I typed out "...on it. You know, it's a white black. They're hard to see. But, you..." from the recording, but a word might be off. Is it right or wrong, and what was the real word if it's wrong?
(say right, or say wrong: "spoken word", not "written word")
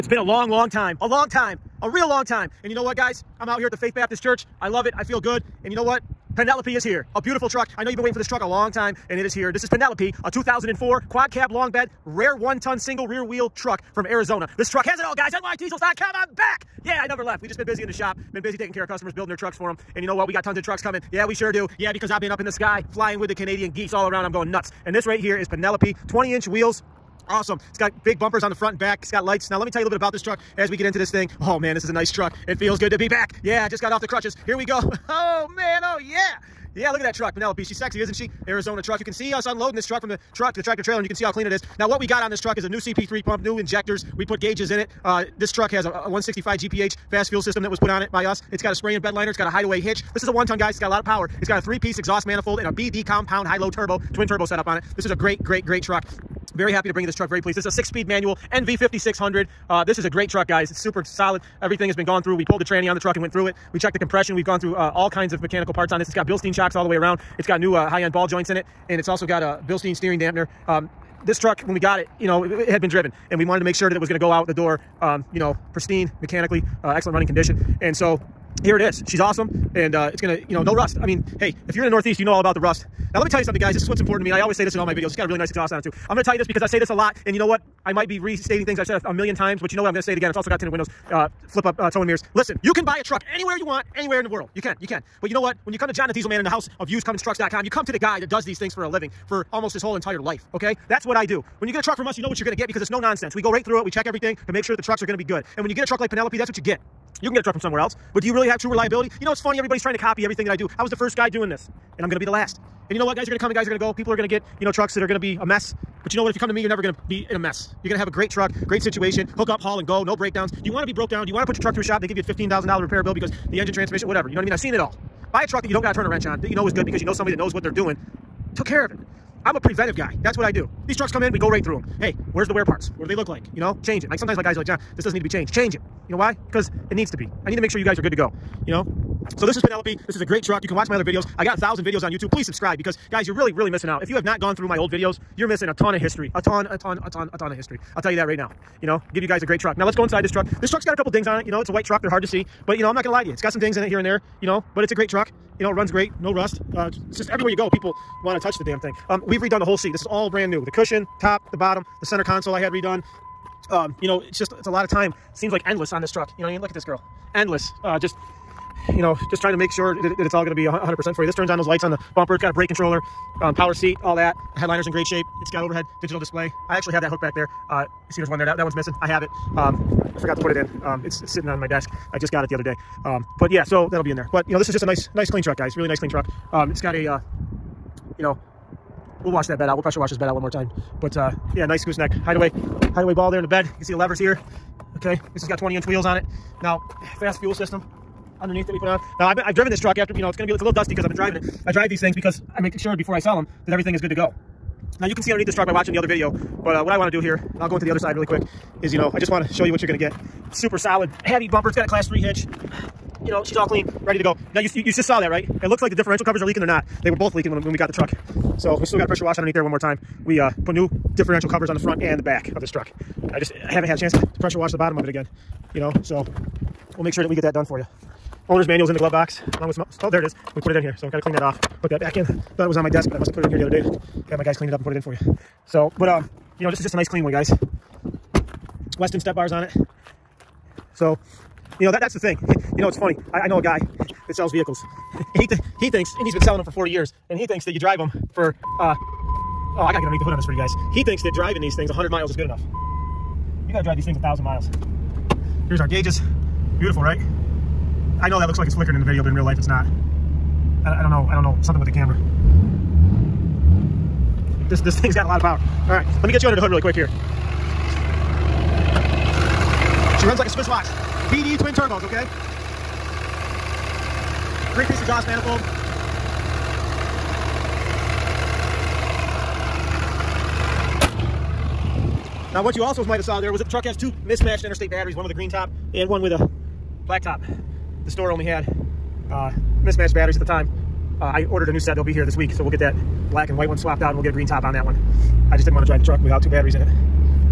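wrong: "truck", not "black".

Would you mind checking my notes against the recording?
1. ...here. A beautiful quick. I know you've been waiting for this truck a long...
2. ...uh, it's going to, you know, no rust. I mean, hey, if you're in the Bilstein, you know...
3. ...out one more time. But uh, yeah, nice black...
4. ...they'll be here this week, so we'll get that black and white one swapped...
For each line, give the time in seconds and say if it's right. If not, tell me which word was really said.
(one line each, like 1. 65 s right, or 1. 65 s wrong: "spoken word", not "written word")
1. 6 s wrong: "truck", not "quick"
2. 79 s wrong: "Northeast", not "Bilstein"
3. 190 s wrong: "gooseneck", not "black"
4. 291 s right.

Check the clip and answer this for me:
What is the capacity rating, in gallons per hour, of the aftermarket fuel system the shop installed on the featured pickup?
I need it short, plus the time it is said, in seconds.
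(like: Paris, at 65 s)
165 GPH, at 46 s.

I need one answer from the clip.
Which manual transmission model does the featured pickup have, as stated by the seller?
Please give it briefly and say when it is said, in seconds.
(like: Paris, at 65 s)
NV 5600, at 58 s.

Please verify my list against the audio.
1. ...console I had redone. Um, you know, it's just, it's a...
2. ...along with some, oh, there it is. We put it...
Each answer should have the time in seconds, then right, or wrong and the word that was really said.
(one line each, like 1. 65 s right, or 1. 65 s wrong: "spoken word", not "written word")
1. 162 s right
2. 229 s right.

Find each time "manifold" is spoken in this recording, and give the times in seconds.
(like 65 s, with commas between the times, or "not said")
52 s, 275 s.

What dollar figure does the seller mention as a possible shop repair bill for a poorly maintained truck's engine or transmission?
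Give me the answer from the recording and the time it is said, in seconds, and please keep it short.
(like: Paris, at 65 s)
$15,000, at 122 s.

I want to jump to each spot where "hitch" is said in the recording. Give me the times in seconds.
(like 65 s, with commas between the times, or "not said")
49 s, 212 s.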